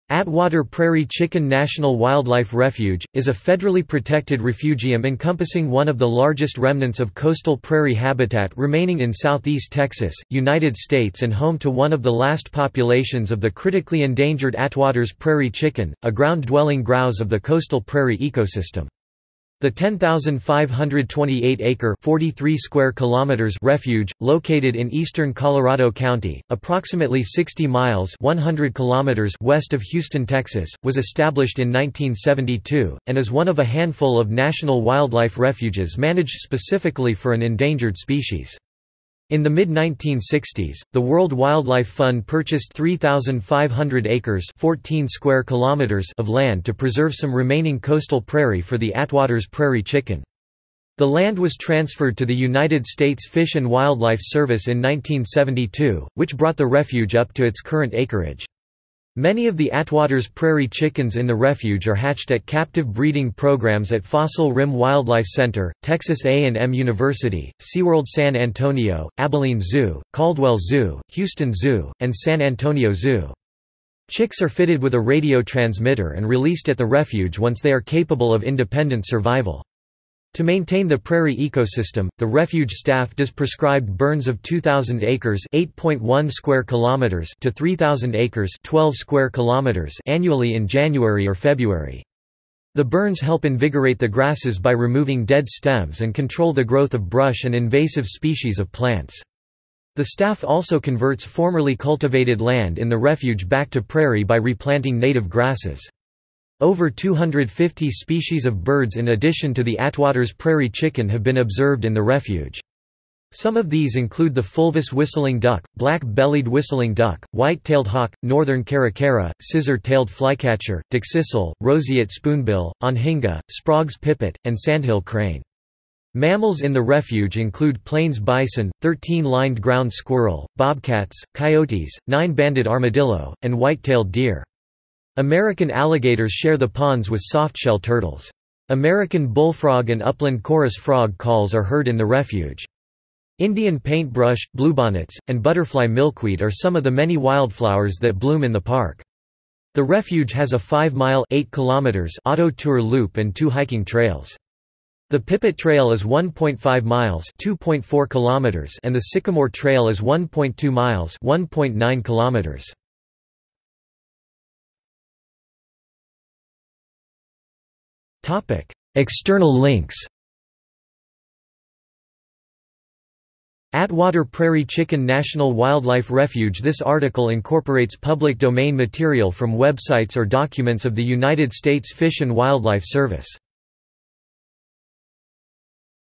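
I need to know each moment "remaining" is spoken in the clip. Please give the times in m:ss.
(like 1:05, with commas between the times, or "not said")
0:08, 0:47.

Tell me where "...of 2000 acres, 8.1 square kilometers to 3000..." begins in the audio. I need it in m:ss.
1:24.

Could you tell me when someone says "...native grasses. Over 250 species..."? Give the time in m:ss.
1:44.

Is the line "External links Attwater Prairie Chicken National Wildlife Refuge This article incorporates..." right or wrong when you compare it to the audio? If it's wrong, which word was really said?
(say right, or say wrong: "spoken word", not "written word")
right.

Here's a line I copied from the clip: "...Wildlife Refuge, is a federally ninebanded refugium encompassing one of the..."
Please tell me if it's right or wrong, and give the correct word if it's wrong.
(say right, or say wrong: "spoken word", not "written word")
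wrong: "protected", not "ninebanded".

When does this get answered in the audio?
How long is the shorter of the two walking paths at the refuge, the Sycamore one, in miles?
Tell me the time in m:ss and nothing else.
2:39.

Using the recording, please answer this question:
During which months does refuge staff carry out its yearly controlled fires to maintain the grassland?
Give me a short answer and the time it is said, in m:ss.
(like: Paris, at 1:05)
January or February, at 1:30.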